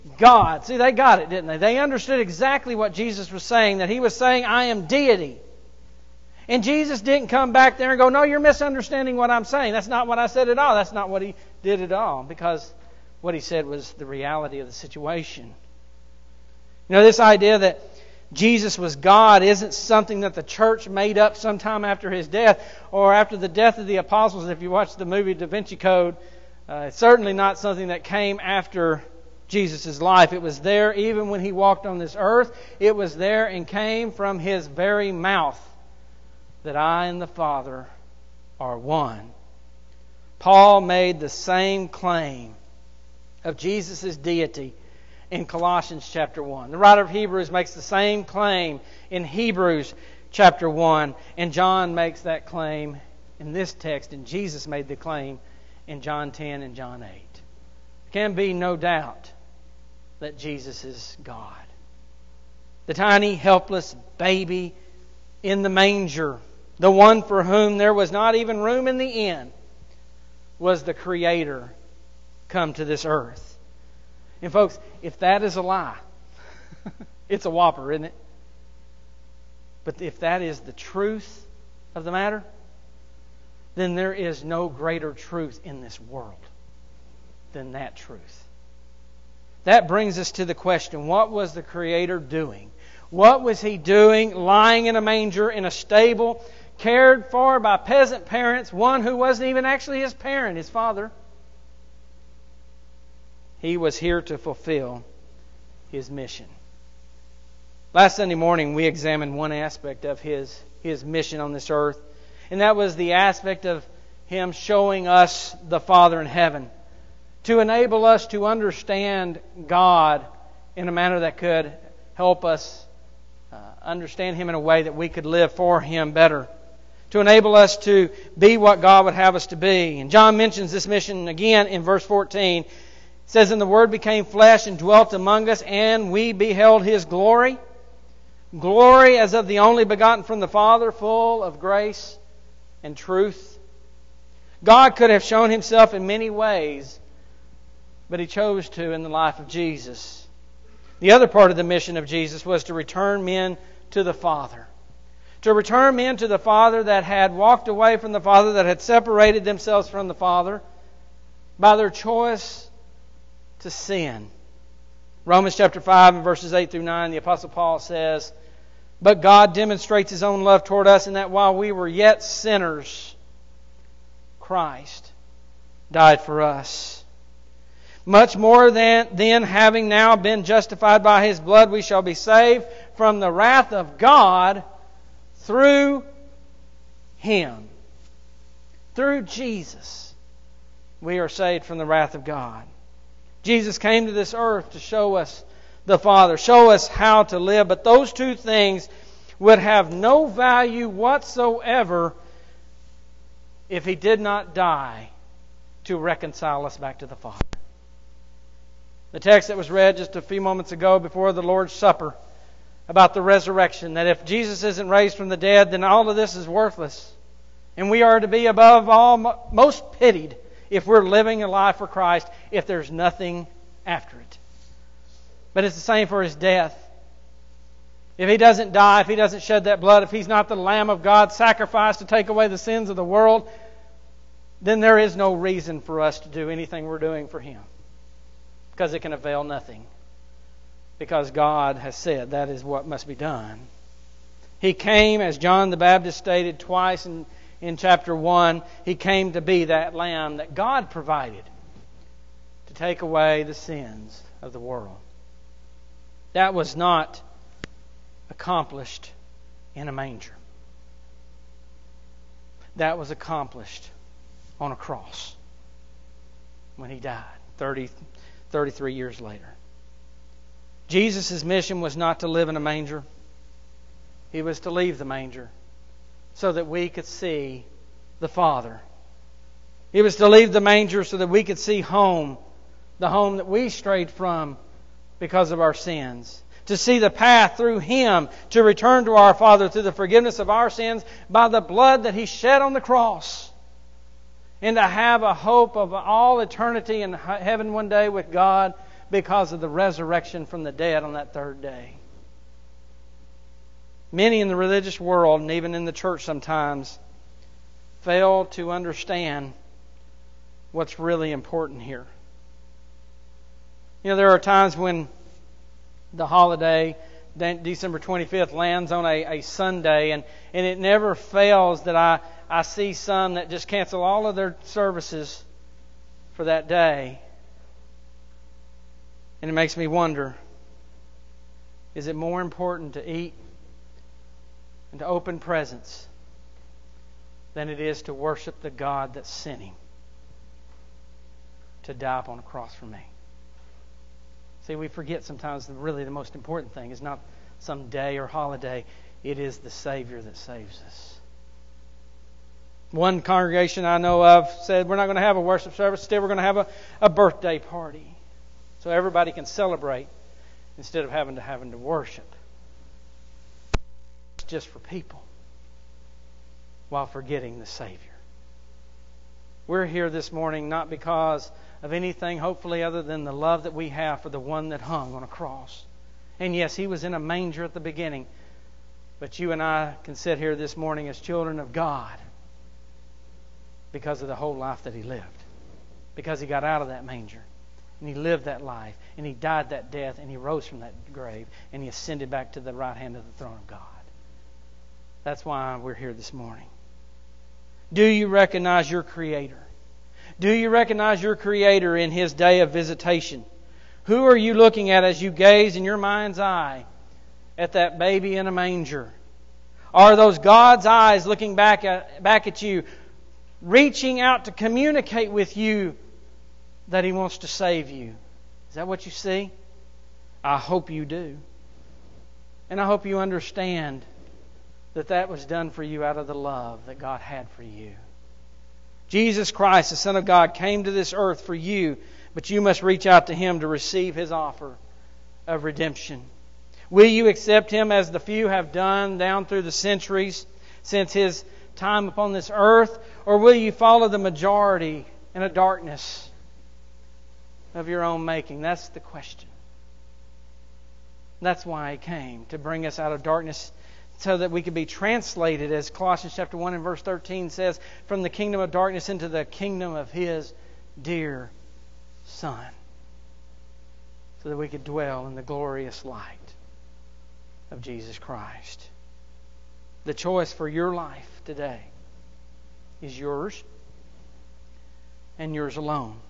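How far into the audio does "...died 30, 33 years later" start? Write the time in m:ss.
4:27.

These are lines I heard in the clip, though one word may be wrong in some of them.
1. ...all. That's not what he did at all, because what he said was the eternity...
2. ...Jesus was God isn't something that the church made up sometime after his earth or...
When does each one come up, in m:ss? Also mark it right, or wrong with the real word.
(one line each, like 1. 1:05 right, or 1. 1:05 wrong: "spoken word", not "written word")
1. 0:10 wrong: "reality", not "eternity"
2. 0:18 wrong: "death", not "earth".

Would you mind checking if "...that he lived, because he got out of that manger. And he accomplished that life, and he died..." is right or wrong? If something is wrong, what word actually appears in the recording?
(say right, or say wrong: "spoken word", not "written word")
wrong: "lived", not "accomplished".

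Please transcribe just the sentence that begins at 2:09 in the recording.
And John mentions this mission again in verse 14.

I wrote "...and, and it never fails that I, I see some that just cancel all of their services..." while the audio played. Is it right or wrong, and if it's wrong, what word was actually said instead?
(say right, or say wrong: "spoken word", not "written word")
right.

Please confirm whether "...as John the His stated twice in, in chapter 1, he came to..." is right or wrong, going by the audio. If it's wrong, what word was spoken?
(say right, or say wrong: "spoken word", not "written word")
wrong: "Baptist", not "His".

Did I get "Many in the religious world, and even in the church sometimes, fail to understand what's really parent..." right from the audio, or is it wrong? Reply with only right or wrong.
wrong.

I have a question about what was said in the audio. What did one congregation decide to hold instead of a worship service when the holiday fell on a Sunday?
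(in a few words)
A birthday party.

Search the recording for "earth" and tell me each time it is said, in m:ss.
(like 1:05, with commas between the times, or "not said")
0:32, 1:13, 1:51, 3:14, 7:11, 7:22.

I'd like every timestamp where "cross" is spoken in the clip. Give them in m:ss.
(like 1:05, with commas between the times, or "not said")
4:24, 4:52, 5:42, 6:15.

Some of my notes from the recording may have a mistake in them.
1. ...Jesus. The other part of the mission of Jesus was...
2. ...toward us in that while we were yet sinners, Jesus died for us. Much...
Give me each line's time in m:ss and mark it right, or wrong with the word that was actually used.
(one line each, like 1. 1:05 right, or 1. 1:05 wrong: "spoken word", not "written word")
1. 2:29 right
2. 2:50 wrong: "Christ", not "Jesus".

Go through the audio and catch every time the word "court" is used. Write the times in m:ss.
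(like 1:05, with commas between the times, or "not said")
not said.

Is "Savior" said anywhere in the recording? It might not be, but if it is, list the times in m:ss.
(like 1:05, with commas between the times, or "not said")
5:49, 6:07.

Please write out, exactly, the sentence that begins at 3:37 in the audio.
And we are to be above all most pitied if we're living a life for Christ if there's nothing after it.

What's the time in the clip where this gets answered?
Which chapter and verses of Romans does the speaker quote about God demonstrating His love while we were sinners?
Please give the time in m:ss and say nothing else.
2:45.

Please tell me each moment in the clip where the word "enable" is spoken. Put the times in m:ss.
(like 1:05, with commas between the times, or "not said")
1:57, 2:07.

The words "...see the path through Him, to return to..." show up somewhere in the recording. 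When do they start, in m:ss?
4:46.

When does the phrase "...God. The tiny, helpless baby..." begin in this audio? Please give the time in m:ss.
1:01.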